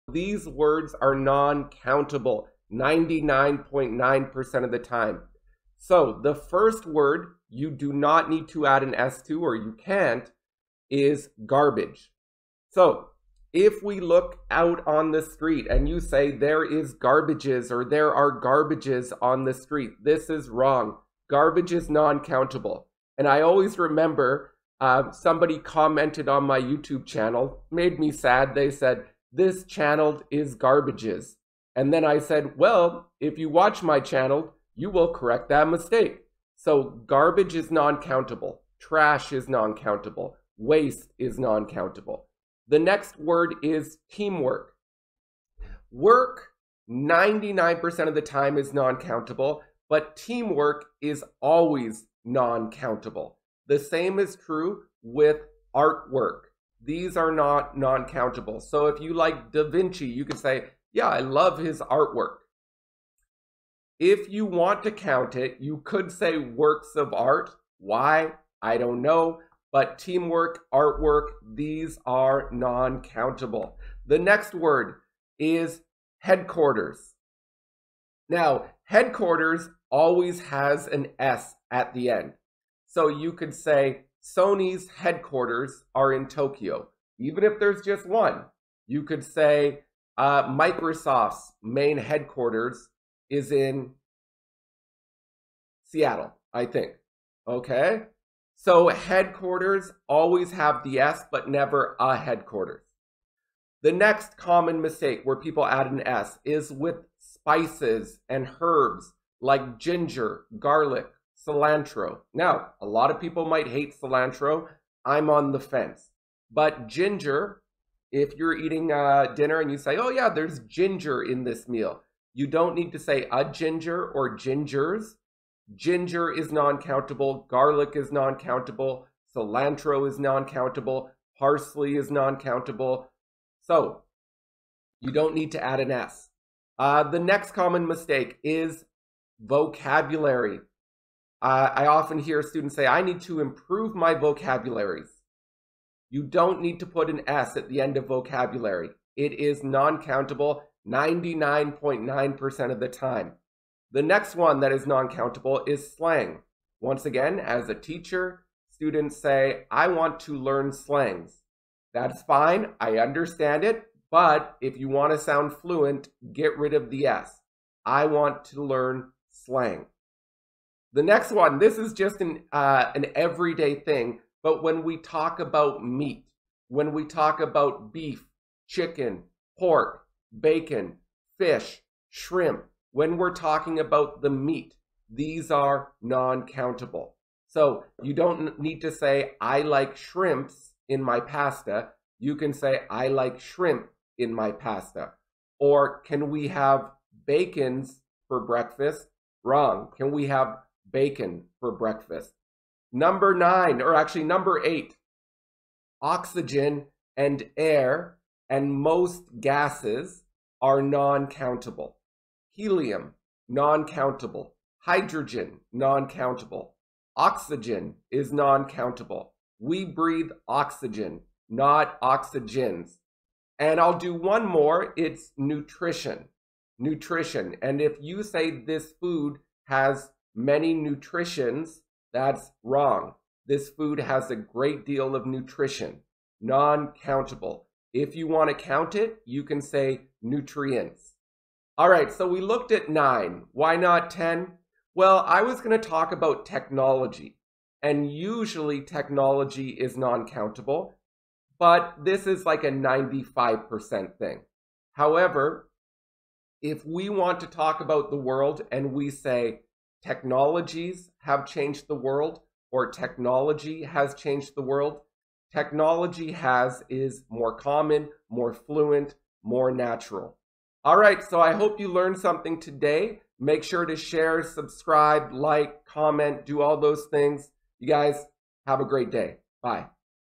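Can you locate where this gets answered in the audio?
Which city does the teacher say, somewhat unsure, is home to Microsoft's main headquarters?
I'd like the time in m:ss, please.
1:35.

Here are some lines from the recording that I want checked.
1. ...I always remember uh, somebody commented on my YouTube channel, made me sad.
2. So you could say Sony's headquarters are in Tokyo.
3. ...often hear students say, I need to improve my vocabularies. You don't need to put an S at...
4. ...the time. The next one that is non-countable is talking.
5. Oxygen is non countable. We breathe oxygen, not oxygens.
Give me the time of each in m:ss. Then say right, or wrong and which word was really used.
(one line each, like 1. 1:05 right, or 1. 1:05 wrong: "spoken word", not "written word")
1. 0:23 right
2. 1:22 right
3. 2:21 right
4. 2:32 wrong: "slang", not "talking"
5. 3:37 right.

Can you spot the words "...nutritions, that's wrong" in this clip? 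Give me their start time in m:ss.
3:50.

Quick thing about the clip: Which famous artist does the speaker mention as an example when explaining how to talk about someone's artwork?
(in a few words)
Da Vinci.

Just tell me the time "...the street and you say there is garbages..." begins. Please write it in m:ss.
0:15.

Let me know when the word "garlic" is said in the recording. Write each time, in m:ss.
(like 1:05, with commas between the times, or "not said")
1:50, 2:07.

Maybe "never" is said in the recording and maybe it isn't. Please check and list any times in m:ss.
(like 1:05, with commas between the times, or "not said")
1:41.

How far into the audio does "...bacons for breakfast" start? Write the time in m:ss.
3:17.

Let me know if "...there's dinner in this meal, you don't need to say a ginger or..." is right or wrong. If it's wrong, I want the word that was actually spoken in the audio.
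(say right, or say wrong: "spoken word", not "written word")
wrong: "ginger", not "dinner".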